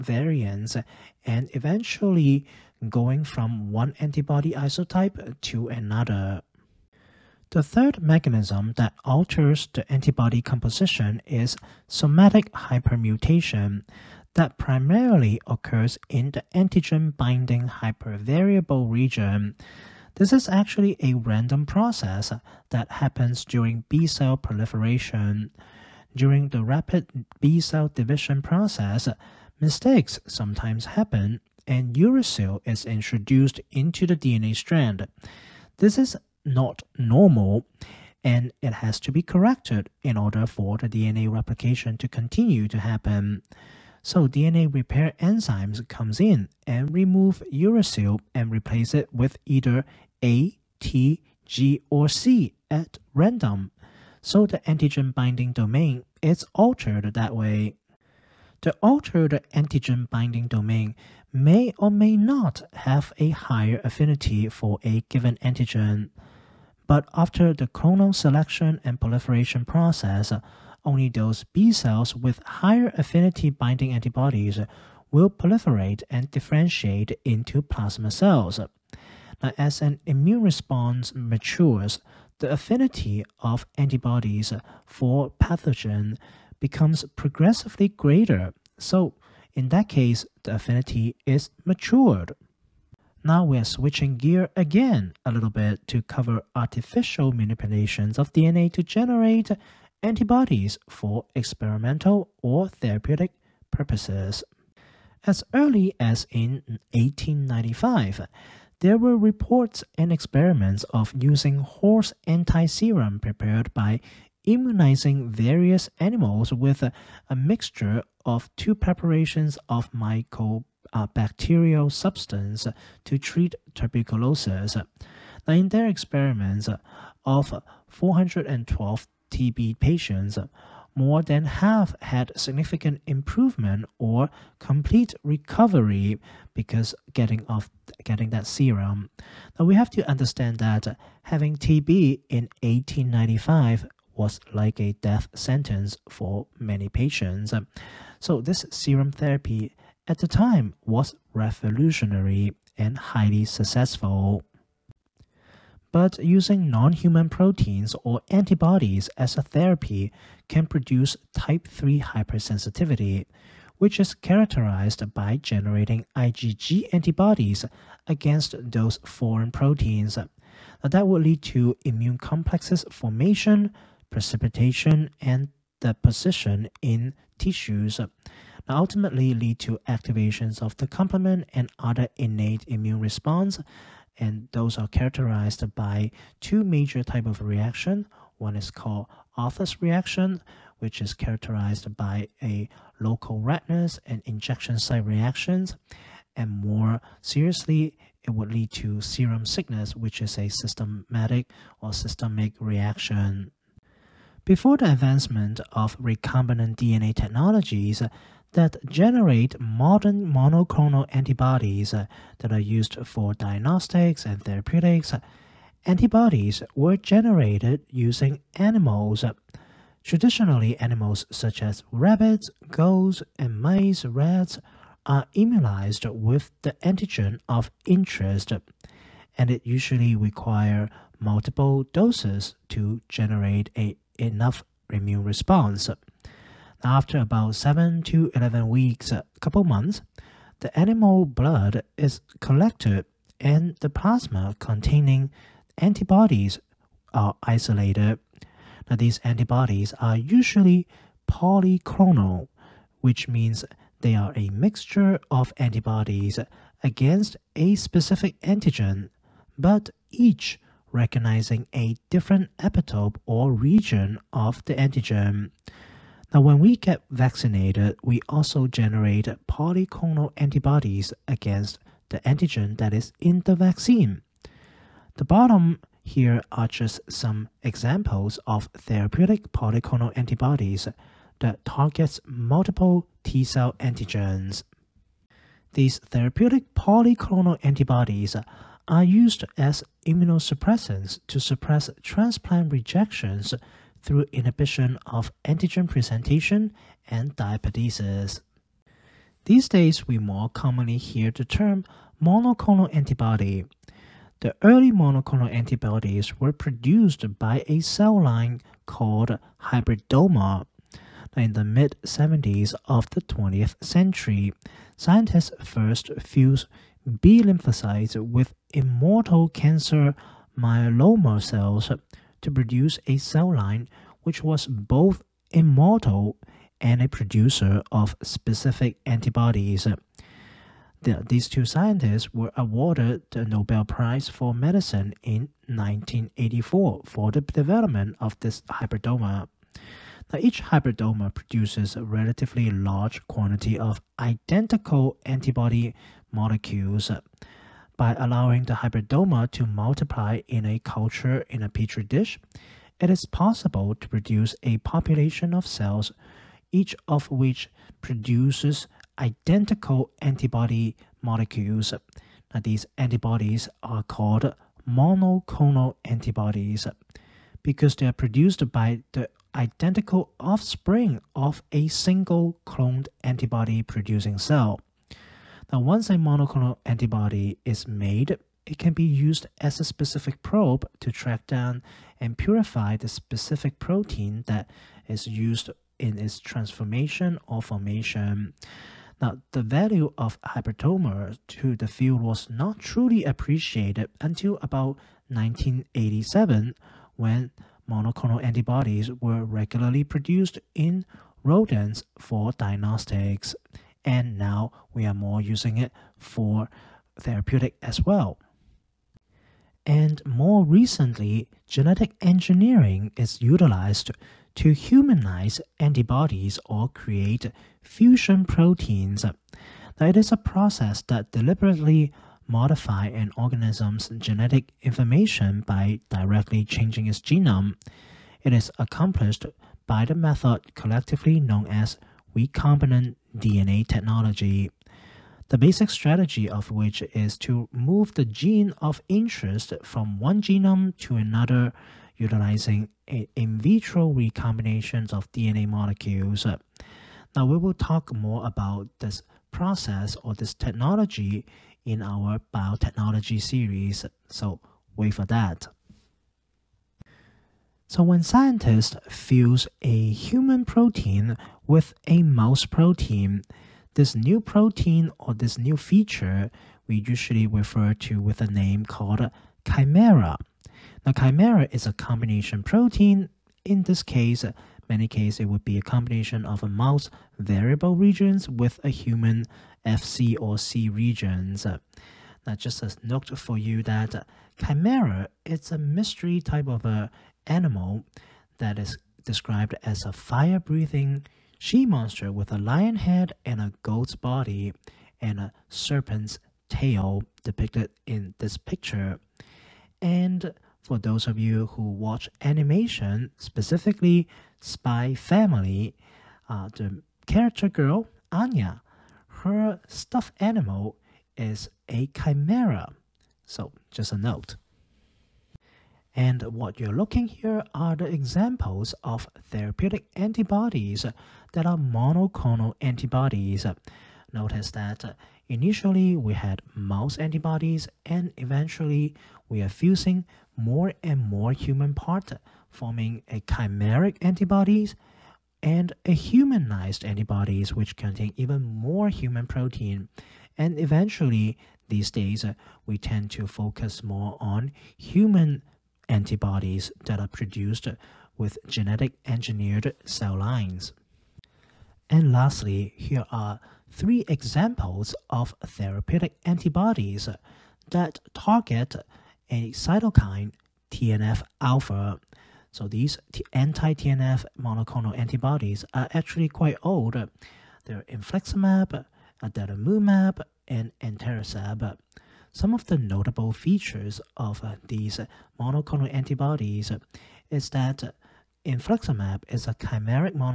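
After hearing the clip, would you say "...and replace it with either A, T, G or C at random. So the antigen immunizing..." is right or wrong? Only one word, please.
wrong.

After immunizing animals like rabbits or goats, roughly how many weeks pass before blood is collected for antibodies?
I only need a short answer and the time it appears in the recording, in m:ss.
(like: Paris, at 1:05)
7 to 11 weeks, at 3:57.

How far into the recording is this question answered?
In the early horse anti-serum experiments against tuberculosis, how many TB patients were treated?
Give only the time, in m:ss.
2:07.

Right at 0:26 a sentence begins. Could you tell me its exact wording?
During the rapid B cell division process, mistakes sometimes happen and uracil is introduced into the DNA strand.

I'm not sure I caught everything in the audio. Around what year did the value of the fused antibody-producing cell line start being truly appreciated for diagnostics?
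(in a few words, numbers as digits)
1987.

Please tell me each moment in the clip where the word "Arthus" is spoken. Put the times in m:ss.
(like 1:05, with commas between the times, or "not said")
3:09.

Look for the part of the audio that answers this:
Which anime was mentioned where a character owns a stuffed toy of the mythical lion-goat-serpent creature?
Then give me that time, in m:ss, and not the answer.
8:24.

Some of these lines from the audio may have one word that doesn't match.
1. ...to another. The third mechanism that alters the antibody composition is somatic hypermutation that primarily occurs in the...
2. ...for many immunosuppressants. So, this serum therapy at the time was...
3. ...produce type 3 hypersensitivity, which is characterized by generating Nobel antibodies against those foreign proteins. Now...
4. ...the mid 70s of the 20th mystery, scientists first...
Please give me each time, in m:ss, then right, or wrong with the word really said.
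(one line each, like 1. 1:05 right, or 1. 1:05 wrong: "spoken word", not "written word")
1. 0:05 right
2. 2:26 wrong: "patients", not "immunosuppressants"
3. 2:40 wrong: "IgG", not "Nobel"
4. 5:11 wrong: "century", not "mystery".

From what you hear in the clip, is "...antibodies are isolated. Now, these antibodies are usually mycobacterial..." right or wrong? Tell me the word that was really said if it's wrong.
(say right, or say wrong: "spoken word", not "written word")
wrong: "polyclonal", not "mycobacterial".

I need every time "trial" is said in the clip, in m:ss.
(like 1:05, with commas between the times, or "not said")
not said.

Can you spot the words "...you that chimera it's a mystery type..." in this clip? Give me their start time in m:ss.
8:03.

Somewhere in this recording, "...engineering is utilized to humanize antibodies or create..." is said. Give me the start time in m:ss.
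6:52.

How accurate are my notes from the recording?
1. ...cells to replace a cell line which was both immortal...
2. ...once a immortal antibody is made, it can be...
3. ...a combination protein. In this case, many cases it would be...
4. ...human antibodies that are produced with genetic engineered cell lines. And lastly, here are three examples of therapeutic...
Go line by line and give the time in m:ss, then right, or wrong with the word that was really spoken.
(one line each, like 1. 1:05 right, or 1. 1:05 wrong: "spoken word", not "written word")
1. 5:21 wrong: "produce", not "replace"
2. 6:15 wrong: "monoclonal", not "immortal"
3. 7:51 right
4. 9:04 right.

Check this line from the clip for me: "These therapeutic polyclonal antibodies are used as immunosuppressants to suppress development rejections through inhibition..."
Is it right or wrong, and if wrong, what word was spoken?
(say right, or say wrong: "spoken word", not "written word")
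wrong: "transplant", not "development".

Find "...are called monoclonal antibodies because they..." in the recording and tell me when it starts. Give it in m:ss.
6:03.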